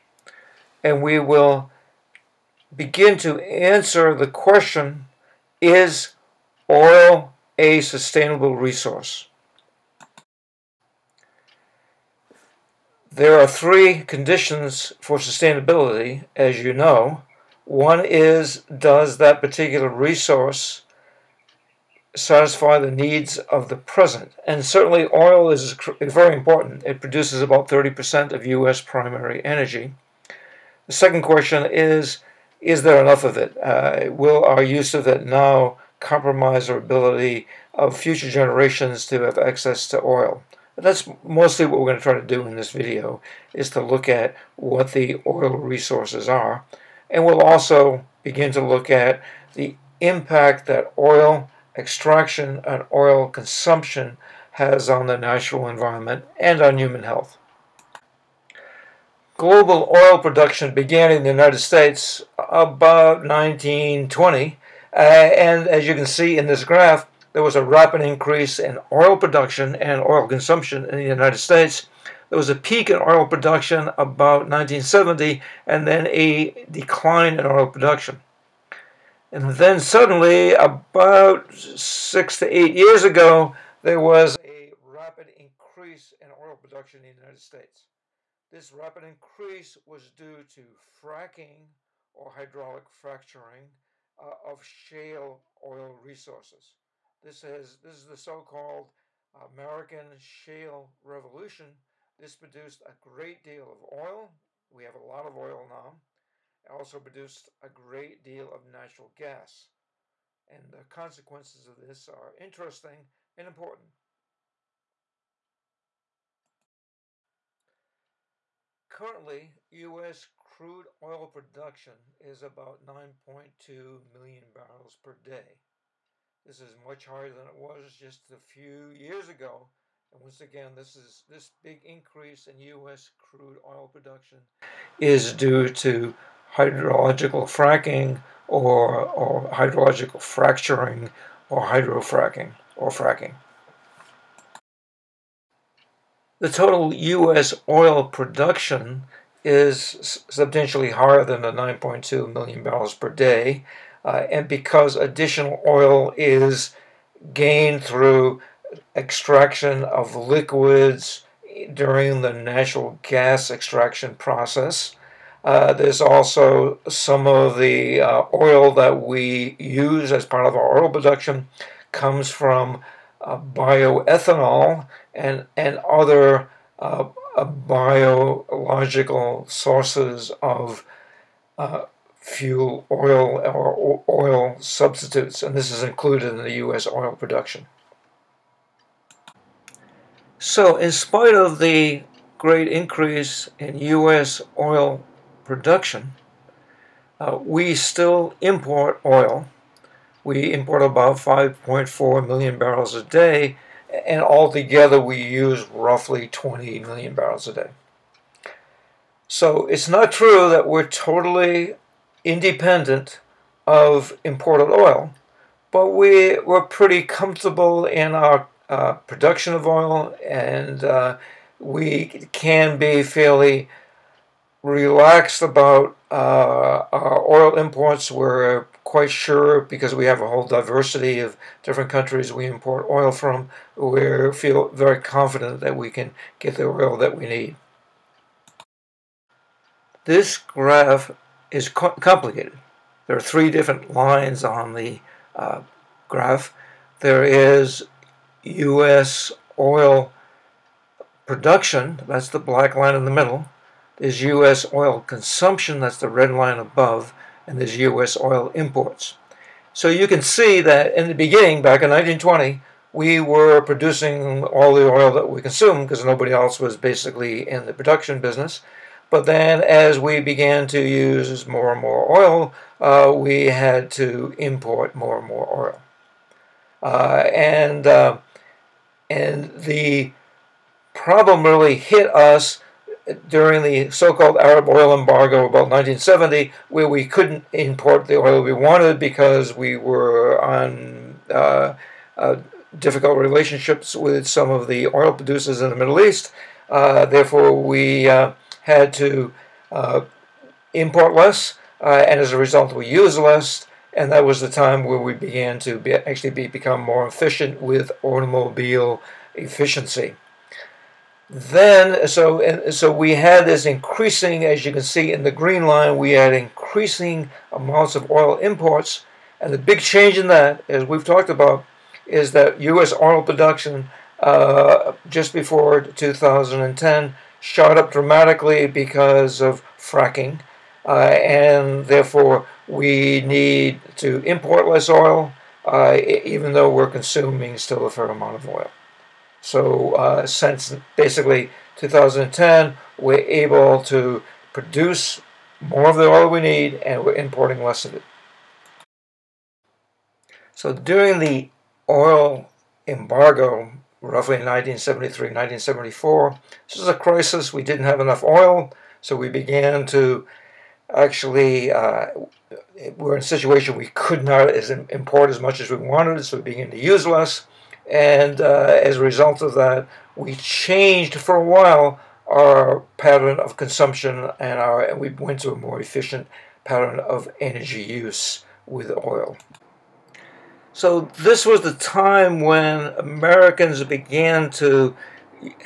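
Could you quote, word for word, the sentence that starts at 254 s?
oil consumption, that's the red line above, and there's U.S.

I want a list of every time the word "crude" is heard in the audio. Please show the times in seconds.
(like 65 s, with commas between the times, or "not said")
120 s, 133 s.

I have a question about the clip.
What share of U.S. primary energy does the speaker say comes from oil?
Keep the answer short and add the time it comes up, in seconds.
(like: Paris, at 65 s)
30%, at 27 s.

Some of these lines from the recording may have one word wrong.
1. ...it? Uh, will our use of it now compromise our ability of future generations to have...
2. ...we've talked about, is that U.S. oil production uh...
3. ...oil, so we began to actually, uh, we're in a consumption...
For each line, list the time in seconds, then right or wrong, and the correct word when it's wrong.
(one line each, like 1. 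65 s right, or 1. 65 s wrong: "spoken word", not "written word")
1. 33 s right
2. 320 s right
3. 358 s wrong: "situation", not "consumption".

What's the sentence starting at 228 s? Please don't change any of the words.
We're quite sure because we have a whole diversity of different countries we import oil from.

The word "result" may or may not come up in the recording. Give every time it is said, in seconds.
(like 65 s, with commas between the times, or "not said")
302 s, 369 s.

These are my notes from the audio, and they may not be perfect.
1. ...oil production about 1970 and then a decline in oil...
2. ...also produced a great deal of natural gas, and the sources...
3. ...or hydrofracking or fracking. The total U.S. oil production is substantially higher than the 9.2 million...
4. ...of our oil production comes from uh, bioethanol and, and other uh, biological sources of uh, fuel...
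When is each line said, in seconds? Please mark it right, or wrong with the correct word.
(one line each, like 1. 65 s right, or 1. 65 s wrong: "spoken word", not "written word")
1. 72 s right
2. 106 s wrong: "consequences", not "sources"
3. 141 s right
4. 170 s right.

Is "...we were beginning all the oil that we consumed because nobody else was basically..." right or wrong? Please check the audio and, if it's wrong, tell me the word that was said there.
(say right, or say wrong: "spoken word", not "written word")
wrong: "producing", not "beginning".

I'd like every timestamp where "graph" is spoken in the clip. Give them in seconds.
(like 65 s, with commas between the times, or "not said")
66 s, 240 s, 246 s.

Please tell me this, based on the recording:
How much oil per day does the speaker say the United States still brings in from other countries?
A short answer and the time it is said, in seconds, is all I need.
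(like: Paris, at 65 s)
5.4 million barrels, at 201 s.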